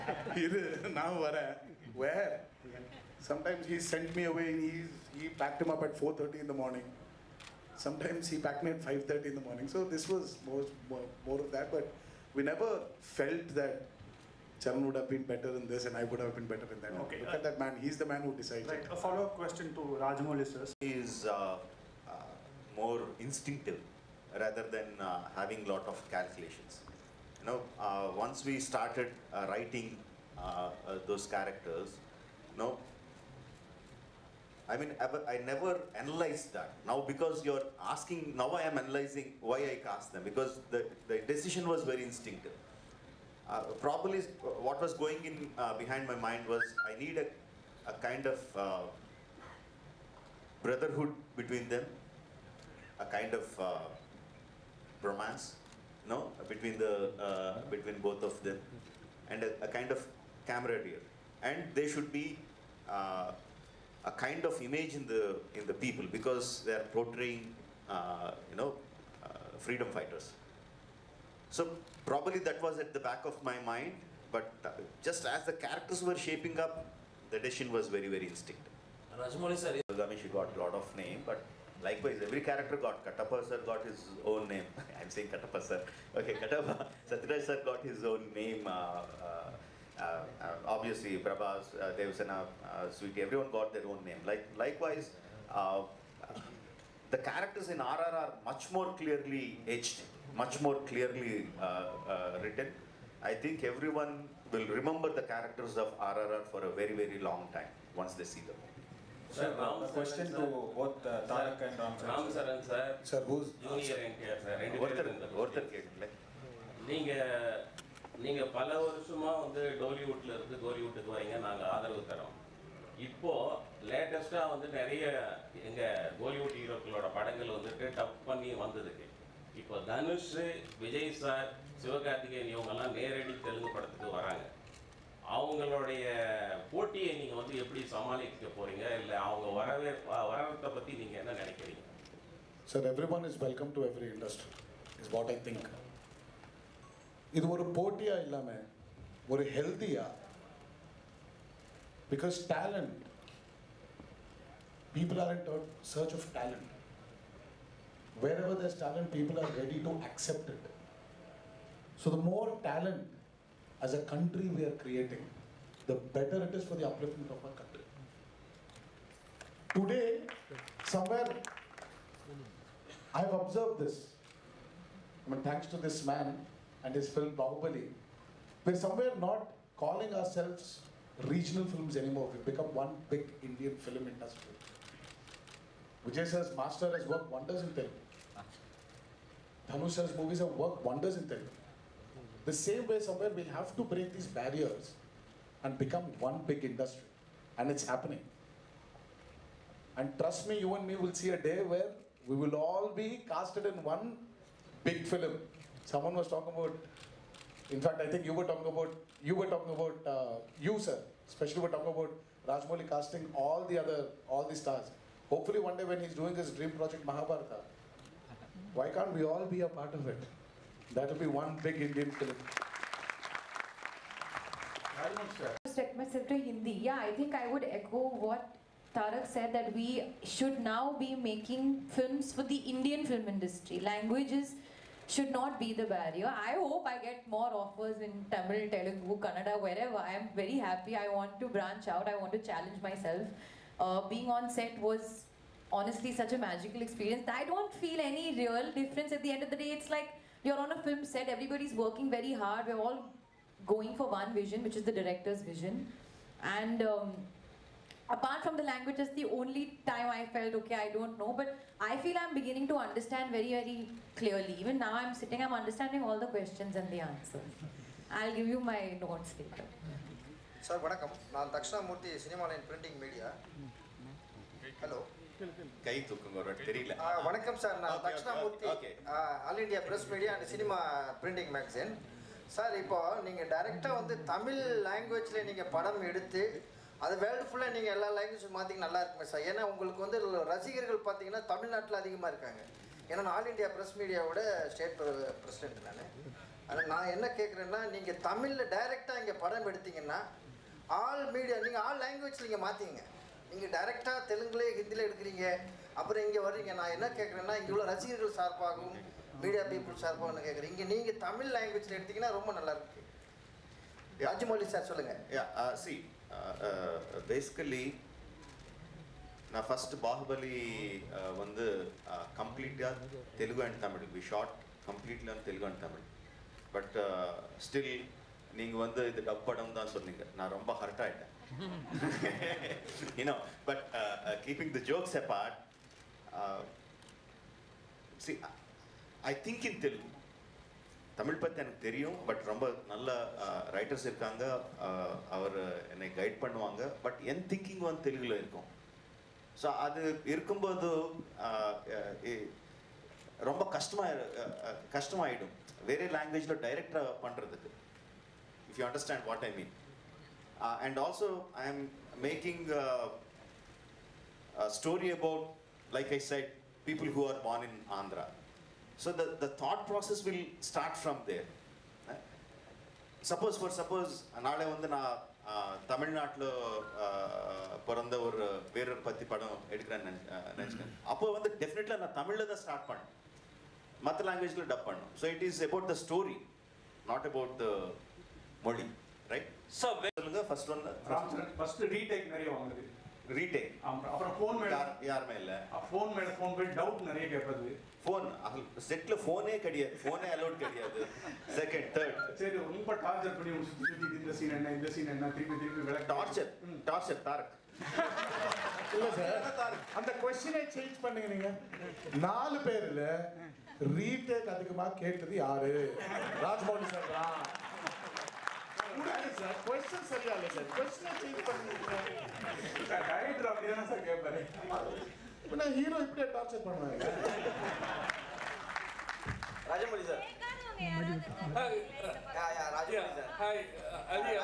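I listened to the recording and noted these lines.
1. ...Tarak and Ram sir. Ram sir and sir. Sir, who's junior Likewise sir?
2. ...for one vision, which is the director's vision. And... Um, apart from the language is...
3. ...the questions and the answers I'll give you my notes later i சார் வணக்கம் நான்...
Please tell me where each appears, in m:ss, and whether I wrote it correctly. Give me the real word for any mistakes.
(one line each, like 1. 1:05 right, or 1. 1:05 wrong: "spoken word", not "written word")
1. 1:51 wrong: "NTR", not "Likewise"
2. 4:13 right
3. 4:26 right.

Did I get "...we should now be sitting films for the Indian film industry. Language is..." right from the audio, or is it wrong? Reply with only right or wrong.
wrong.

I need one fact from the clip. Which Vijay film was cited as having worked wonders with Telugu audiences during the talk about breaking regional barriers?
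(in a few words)
Master.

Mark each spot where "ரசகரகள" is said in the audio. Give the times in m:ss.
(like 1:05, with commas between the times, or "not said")
4:50, 5:07.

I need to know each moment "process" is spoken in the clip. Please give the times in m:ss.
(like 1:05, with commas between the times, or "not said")
6:09.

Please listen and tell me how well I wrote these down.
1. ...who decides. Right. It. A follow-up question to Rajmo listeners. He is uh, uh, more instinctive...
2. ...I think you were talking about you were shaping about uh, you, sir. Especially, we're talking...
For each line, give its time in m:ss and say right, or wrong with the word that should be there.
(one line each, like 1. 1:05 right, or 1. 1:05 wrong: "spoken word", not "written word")
1. 0:18 right
2. 3:28 wrong: "talking", not "shaping".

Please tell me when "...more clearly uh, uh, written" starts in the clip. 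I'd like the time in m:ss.
1:40.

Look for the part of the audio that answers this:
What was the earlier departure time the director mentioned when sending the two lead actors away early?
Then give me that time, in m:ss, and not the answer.
0:05.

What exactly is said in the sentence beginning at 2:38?
Wherever there's talent, people are ready to accept it.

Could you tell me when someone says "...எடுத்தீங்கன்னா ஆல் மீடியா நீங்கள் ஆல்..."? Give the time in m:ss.
4:59.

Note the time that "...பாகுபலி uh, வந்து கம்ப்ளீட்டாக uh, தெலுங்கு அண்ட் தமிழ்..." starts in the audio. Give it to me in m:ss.
5:20.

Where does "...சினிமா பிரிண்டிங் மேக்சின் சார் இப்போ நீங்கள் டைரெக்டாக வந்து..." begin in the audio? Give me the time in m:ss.
4:40.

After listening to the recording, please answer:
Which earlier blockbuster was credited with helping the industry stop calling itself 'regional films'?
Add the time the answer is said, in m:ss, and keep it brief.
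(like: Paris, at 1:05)
Bahubali, at 2:57.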